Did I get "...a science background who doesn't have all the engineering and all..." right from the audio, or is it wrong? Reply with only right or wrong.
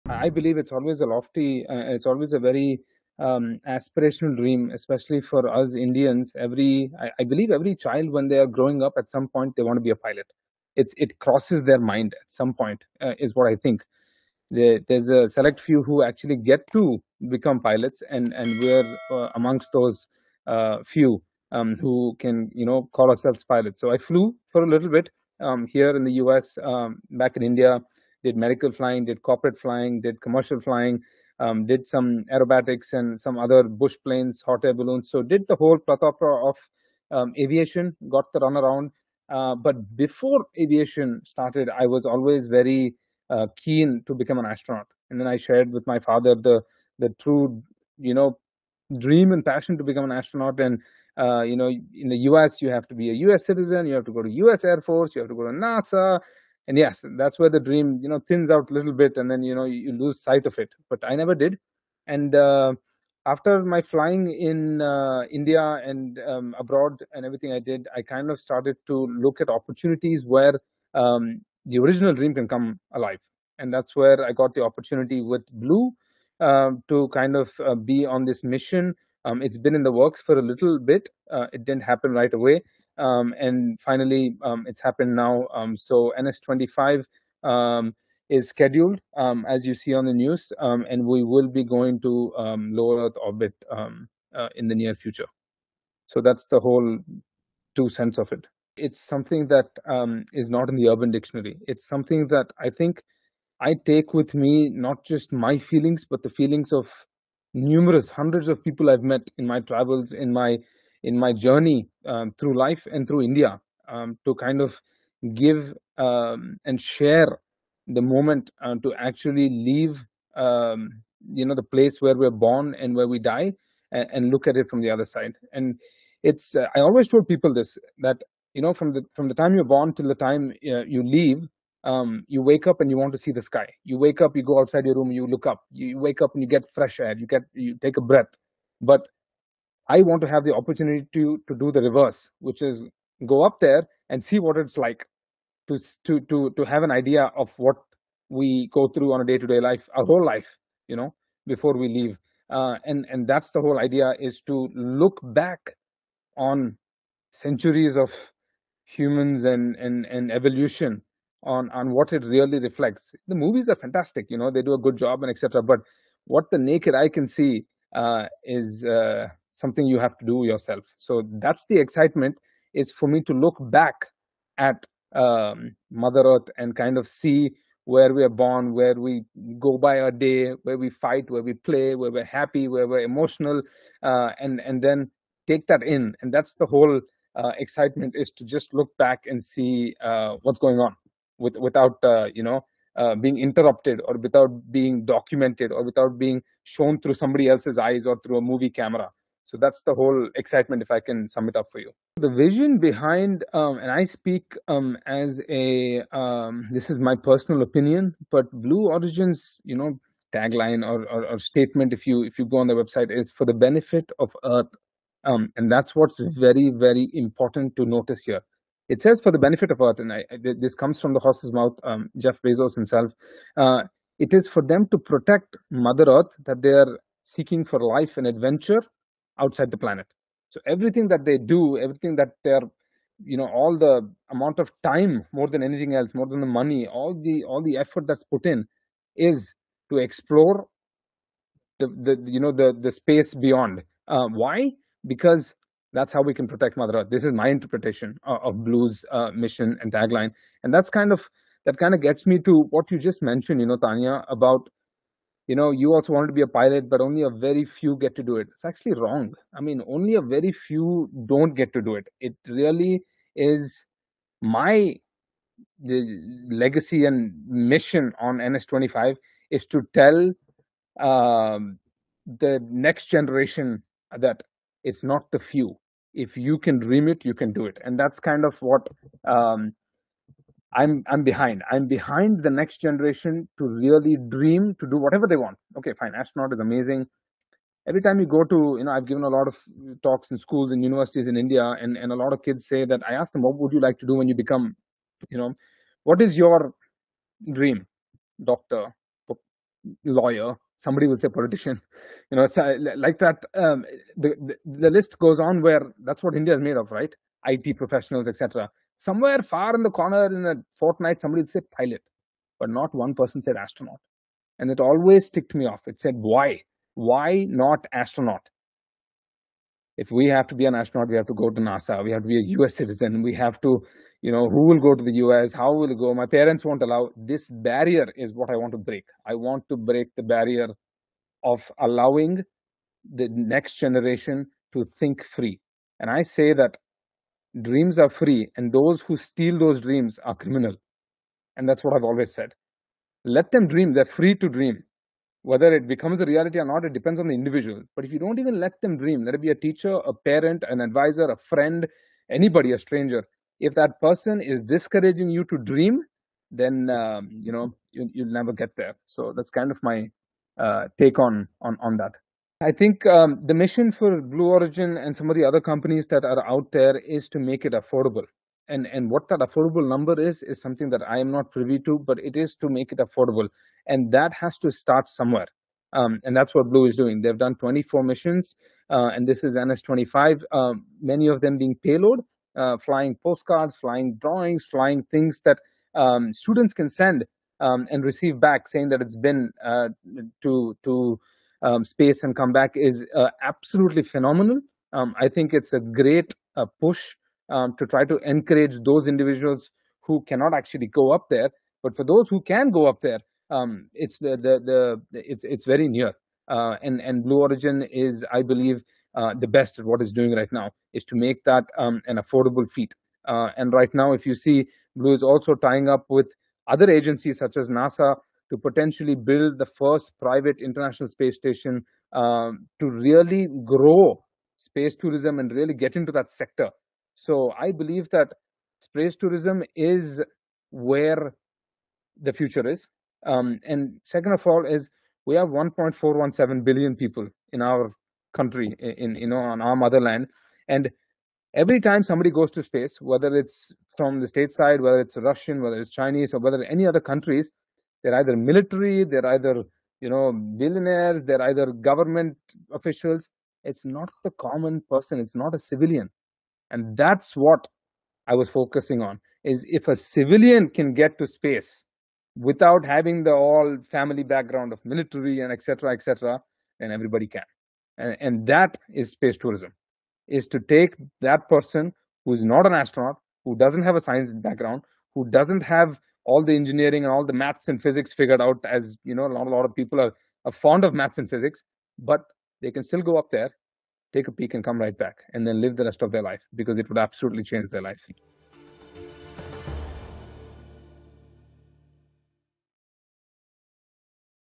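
right.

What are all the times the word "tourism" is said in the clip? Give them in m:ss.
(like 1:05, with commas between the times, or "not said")
7:04, 7:09, 7:49.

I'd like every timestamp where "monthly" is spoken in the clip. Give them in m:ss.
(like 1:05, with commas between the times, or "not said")
not said.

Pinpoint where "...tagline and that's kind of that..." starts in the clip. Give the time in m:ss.
4:09.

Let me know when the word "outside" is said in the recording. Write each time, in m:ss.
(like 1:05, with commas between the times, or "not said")
2:14, 3:49.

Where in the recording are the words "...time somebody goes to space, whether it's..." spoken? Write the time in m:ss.
7:21.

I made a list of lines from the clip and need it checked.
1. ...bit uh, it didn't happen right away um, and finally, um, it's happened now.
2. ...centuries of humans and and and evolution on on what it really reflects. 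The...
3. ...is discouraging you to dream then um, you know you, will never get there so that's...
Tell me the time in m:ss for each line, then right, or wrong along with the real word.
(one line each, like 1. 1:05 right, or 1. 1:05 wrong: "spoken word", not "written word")
1. 1:20 right
2. 2:37 right
3. 5:54 right.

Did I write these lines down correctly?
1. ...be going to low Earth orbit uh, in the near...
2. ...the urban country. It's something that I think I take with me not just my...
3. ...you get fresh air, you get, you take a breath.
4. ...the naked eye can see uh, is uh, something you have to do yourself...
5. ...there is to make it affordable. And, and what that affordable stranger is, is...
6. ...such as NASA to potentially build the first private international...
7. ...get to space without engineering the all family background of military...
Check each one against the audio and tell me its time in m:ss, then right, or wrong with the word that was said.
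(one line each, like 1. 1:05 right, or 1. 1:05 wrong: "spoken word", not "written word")
1. 1:31 right
2. 1:40 wrong: "dictionary", not "country"
3. 2:16 right
4. 2:46 right
5. 6:06 wrong: "number", not "stranger"
6. 6:57 right
7. 7:40 wrong: "having", not "engineering".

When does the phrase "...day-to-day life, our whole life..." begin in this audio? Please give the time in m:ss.
2:29.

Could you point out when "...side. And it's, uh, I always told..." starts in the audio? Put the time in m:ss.
2:05.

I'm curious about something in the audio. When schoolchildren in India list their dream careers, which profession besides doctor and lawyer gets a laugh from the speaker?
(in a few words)
politician.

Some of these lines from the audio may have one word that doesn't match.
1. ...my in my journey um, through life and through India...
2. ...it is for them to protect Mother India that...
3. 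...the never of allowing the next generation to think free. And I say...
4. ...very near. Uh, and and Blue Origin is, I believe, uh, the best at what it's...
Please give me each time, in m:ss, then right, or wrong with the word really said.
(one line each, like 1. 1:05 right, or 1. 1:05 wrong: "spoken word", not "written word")
1. 1:50 right
2. 3:44 wrong: "Earth", not "India"
3. 5:30 wrong: "barrier", not "never"
4. 6:45 right.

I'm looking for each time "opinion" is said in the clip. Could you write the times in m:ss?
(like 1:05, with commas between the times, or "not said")
3:27.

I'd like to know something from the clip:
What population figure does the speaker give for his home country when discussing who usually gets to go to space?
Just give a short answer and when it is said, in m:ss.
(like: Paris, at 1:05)
1.417 billion, at 7:15.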